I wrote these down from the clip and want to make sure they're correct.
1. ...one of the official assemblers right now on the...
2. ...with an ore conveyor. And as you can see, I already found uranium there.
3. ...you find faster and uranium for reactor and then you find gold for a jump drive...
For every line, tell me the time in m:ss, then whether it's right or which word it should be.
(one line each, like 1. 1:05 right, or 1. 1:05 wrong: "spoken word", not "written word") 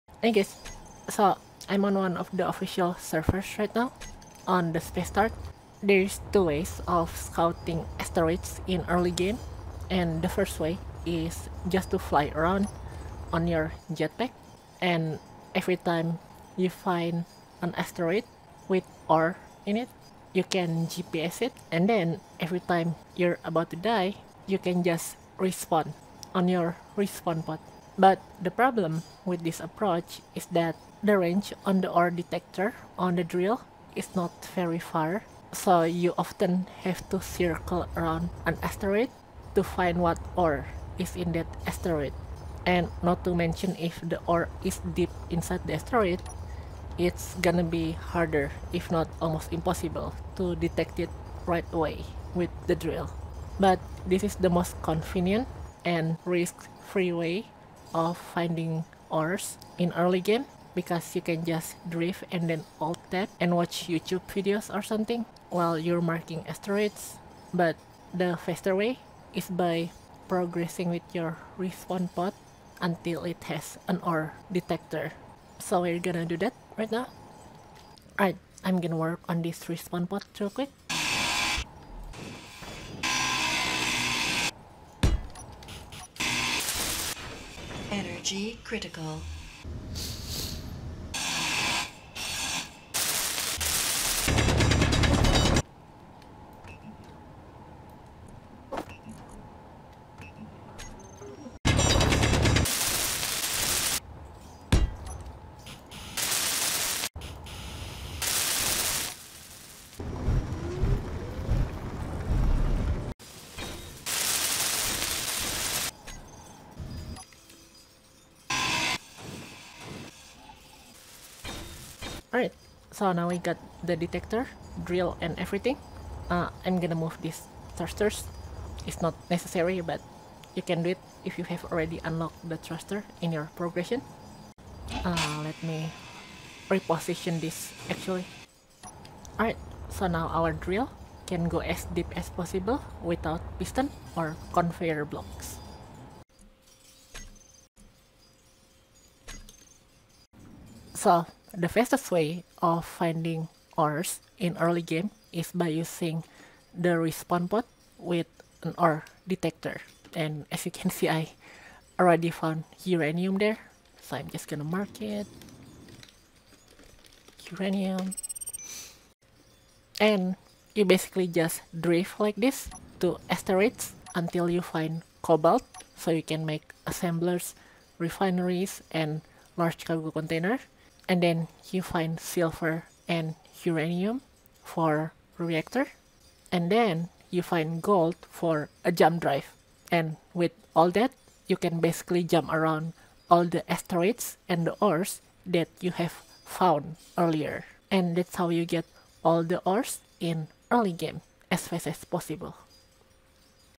1. 0:01 wrong: "servers", not "assemblers"
2. 2:37 wrong: "detector", not "conveyor"
3. 3:01 wrong: "silver", not "faster".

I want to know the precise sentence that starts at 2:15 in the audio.
Uh, let me reposition this actually.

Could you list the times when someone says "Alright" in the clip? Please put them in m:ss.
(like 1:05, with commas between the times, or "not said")
1:18, 2:02, 2:19.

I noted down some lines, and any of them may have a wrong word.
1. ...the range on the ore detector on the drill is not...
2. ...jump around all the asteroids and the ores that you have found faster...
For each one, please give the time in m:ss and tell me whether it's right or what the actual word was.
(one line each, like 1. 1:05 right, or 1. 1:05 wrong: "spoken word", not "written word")
1. 0:31 right
2. 3:12 wrong: "earlier", not "faster".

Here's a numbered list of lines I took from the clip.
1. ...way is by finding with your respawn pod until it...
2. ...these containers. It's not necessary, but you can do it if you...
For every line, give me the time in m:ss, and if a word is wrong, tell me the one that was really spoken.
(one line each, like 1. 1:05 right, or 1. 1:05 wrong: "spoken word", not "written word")
1. 1:08 wrong: "progressing", not "finding"
2. 2:07 wrong: "thrusters", not "containers".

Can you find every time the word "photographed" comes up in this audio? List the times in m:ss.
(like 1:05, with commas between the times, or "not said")
not said.